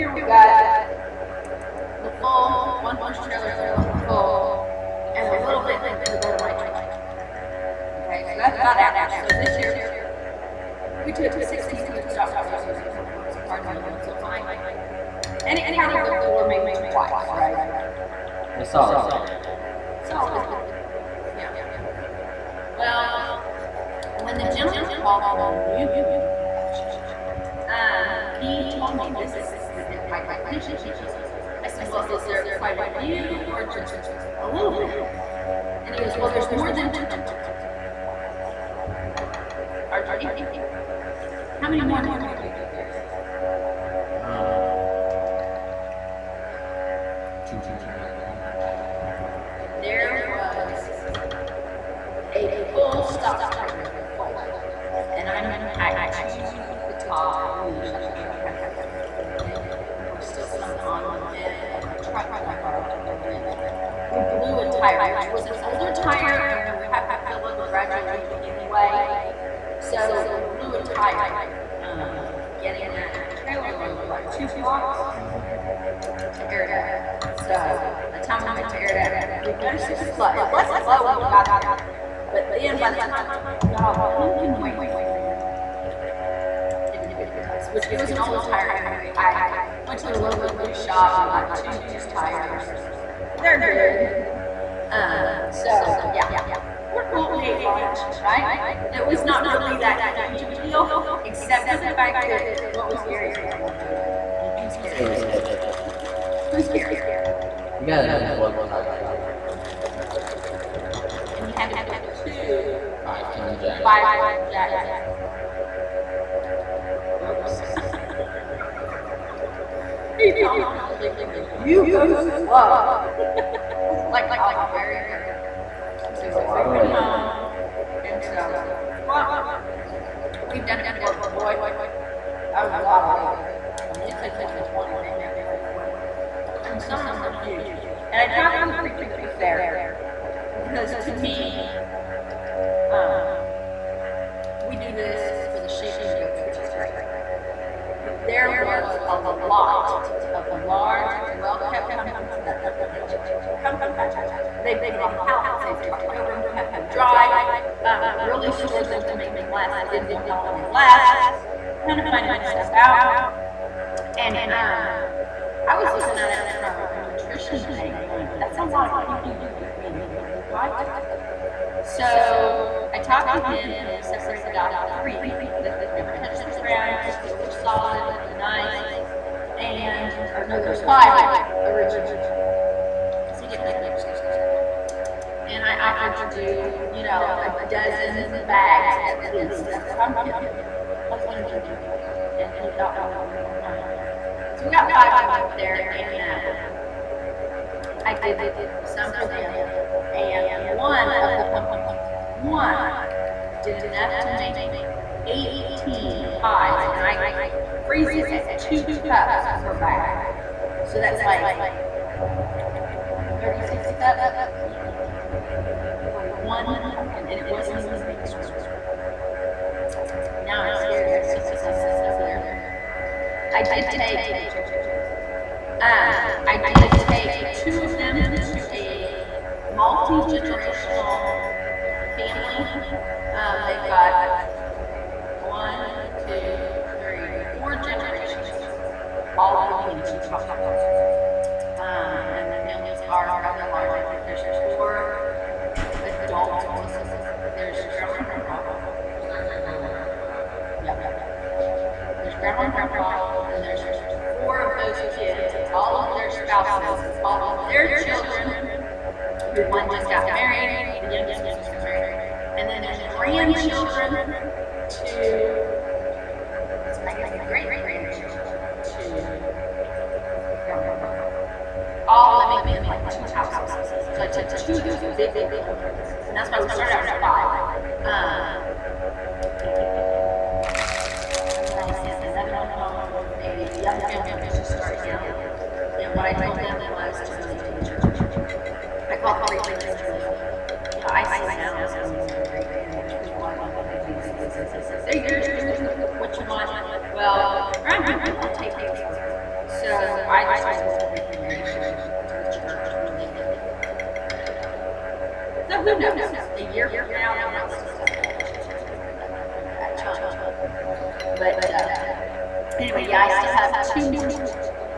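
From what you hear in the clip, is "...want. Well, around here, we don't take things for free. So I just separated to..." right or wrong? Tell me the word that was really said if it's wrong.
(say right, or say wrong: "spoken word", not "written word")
wrong: "wanted", not "separated".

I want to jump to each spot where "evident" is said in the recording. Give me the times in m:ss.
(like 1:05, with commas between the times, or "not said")
not said.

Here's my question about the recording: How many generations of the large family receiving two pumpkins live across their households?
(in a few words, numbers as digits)
4.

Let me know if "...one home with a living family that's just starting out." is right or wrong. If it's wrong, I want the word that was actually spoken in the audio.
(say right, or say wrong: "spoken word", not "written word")
wrong: "young", not "living".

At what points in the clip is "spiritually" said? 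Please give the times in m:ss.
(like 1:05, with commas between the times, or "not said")
not said.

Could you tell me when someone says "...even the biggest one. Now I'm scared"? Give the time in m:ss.
3:37.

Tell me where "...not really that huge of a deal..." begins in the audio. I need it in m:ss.
1:39.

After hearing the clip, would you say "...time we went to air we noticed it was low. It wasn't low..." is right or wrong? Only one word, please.
right.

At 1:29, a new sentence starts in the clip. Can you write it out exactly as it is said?
I went to the local used shop and got two used tires.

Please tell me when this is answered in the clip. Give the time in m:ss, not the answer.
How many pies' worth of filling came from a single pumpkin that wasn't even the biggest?
3:25.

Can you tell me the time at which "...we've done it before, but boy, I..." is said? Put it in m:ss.
2:10.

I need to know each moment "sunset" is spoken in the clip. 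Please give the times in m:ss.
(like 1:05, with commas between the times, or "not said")
3:41.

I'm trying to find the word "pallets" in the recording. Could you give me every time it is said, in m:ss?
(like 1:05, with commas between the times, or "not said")
2:35.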